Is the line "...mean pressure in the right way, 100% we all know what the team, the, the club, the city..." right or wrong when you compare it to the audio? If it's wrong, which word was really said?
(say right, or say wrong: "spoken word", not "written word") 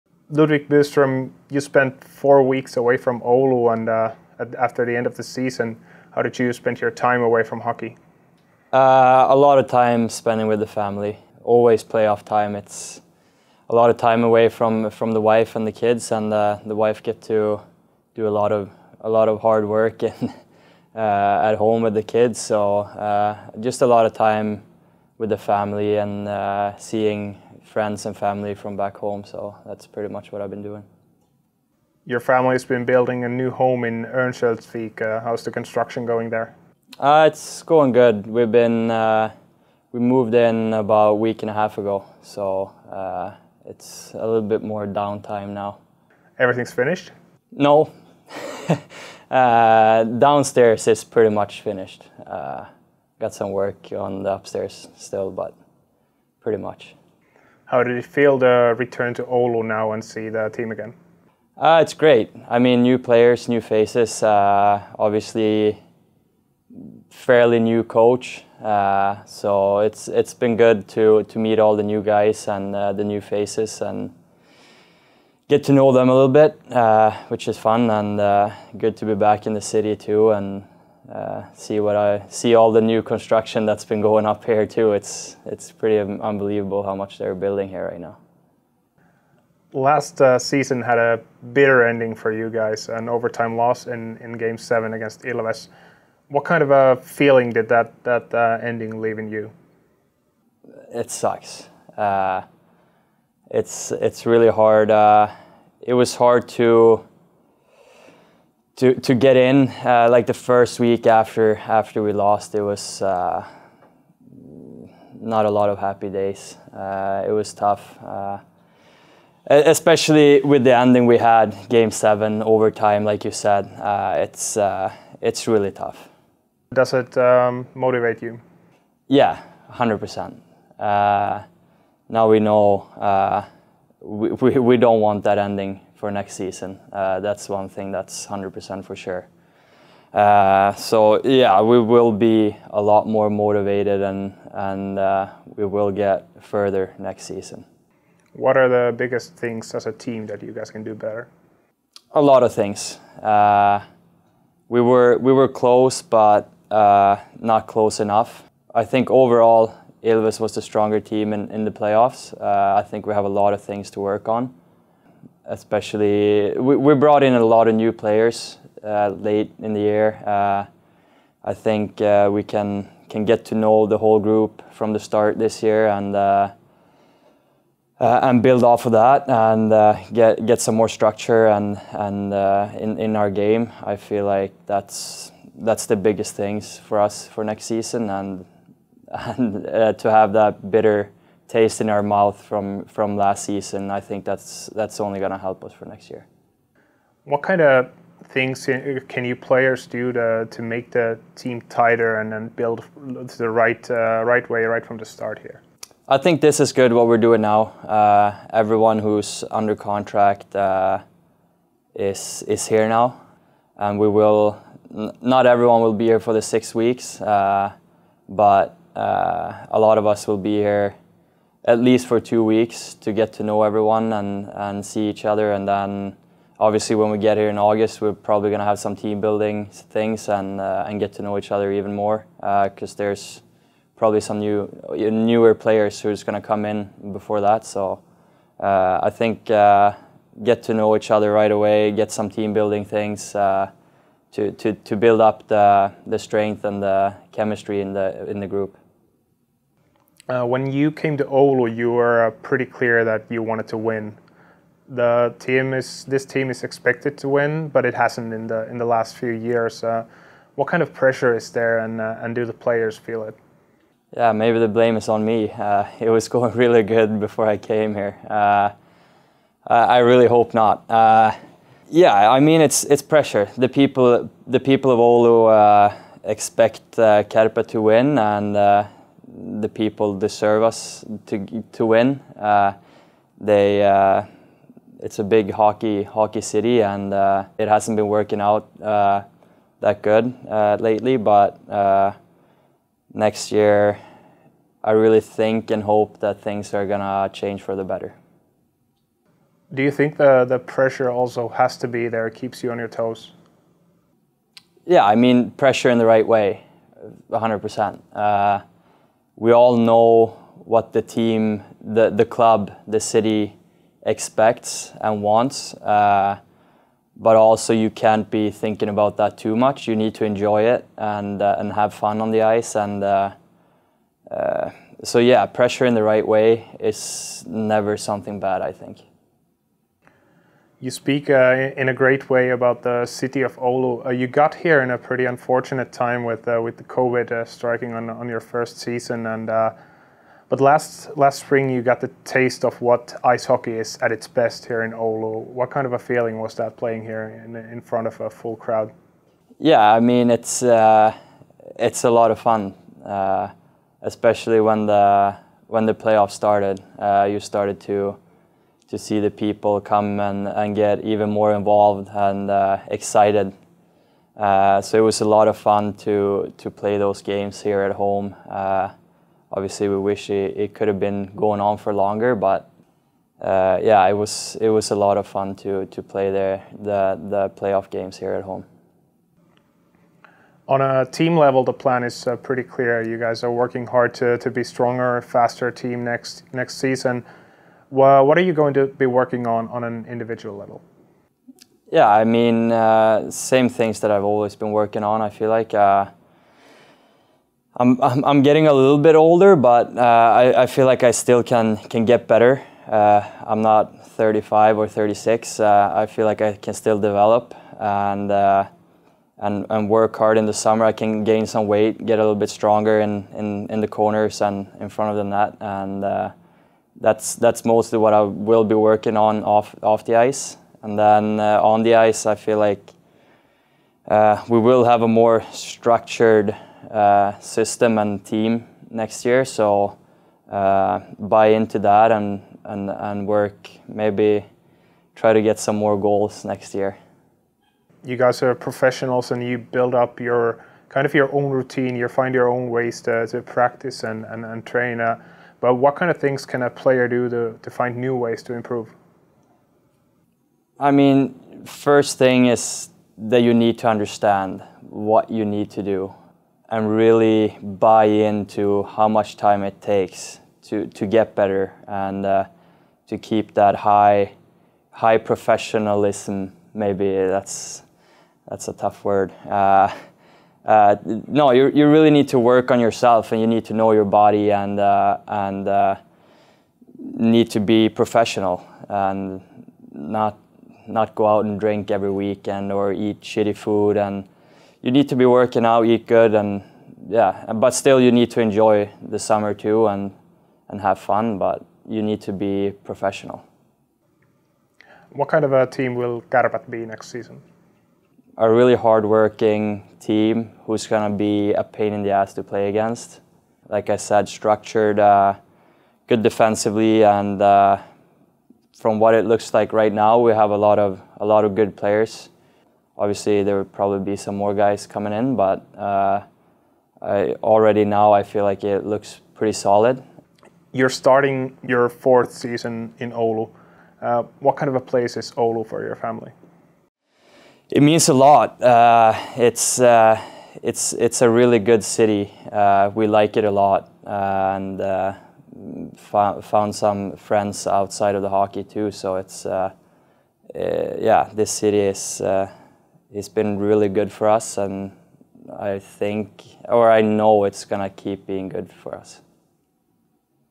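right.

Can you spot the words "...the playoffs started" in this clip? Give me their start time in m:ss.
5:55.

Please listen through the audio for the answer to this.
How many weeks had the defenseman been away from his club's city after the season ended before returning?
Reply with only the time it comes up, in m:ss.
0:02.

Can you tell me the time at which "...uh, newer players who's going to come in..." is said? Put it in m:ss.
3:54.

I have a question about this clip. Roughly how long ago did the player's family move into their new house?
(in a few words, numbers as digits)
A week and a half.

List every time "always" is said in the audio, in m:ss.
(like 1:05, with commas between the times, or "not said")
0:11, 6:34.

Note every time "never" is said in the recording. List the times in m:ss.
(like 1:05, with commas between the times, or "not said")
5:27.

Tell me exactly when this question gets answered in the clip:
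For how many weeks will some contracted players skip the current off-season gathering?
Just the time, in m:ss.
3:36.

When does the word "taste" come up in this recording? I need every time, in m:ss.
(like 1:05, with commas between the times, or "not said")
3:11, 5:42.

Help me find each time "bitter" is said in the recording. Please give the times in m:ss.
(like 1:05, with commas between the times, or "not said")
1:31, 3:10.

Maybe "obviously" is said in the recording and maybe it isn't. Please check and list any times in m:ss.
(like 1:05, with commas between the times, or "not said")
1:04, 3:46, 6:09, 8:32.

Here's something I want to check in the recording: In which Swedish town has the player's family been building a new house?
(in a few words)
Örnsköldsvik.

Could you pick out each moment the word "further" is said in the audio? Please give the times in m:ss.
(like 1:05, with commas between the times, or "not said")
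2:26.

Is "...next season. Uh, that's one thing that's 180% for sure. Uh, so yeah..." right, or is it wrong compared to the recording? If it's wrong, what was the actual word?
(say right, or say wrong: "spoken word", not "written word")
wrong: "100", not "180".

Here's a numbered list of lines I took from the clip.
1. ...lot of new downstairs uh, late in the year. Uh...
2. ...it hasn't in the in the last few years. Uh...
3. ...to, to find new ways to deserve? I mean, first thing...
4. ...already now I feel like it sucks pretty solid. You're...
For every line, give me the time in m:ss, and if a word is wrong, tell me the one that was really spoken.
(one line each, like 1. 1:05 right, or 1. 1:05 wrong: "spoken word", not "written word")
1. 2:47 wrong: "players", not "downstairs"
2. 4:17 right
3. 7:27 wrong: "improve", not "deserve"
4. 8:37 wrong: "looks", not "sucks".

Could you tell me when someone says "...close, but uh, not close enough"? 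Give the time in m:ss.
2:35.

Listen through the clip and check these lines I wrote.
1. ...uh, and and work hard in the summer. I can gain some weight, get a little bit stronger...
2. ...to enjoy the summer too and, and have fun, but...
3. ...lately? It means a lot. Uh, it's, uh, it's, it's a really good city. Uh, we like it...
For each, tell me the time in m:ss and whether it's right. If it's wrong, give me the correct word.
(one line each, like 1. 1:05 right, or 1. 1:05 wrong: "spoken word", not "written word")
1. 6:48 right
2. 8:08 right
3. 8:45 wrong: "family", not "lately".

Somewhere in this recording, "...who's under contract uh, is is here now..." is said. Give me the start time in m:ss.
3:28.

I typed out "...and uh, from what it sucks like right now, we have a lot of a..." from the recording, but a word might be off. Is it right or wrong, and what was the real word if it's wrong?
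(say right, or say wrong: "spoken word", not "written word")
wrong: "looks", not "sucks".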